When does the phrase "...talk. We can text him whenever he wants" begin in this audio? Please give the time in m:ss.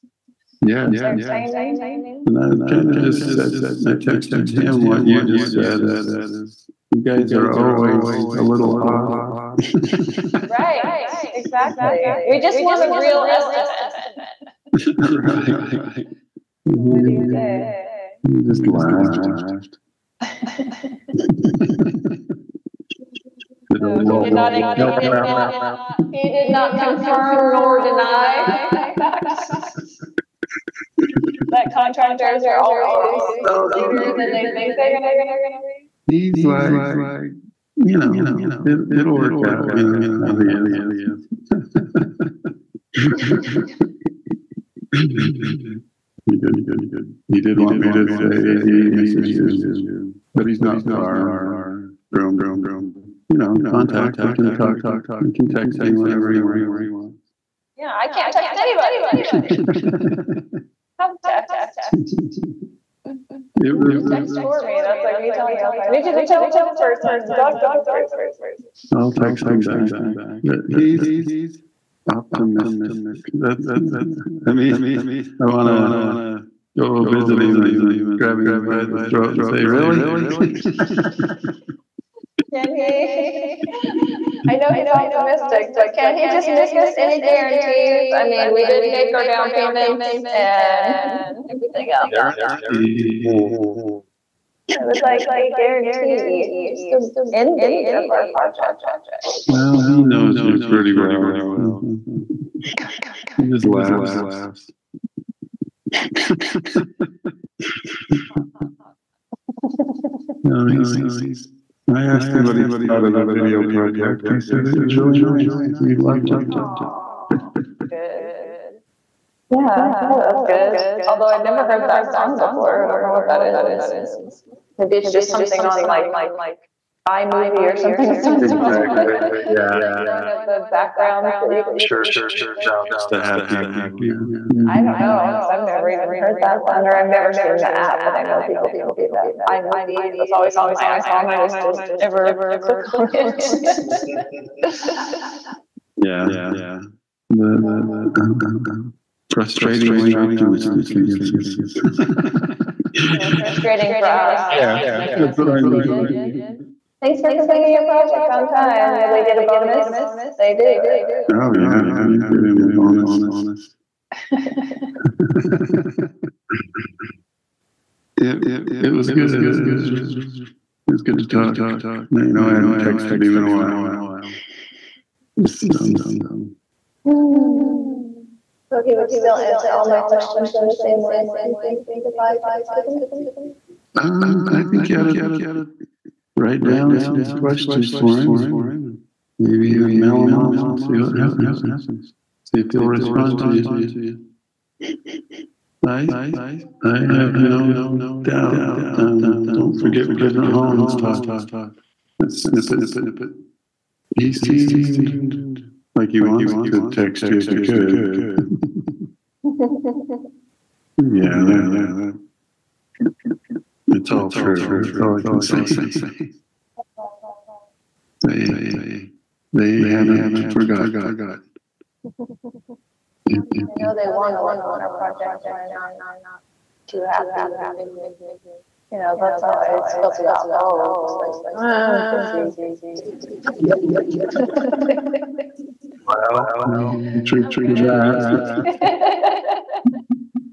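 0:54.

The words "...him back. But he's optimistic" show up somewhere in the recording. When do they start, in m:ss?
1:09.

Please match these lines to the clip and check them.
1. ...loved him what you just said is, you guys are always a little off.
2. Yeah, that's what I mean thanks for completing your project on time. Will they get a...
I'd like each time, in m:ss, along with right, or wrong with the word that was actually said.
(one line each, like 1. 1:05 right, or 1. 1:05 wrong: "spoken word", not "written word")
1. 0:03 wrong: "texted", not "loved"
2. 2:34 right.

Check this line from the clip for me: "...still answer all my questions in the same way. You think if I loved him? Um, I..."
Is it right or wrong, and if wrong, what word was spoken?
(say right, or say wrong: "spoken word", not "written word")
wrong: "texted", not "loved".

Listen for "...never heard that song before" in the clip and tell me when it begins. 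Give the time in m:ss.
2:01.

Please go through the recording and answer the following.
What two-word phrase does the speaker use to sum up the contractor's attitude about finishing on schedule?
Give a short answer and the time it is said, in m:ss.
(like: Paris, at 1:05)
frustratingly optimistic, at 2:29.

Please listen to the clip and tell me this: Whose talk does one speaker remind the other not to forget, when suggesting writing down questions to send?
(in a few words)
President Holland.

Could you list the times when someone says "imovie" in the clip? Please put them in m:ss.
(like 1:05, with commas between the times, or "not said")
2:07, 2:19.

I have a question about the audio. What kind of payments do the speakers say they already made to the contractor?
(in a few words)
down payments.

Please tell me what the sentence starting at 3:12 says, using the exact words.
See if he'll respond to you.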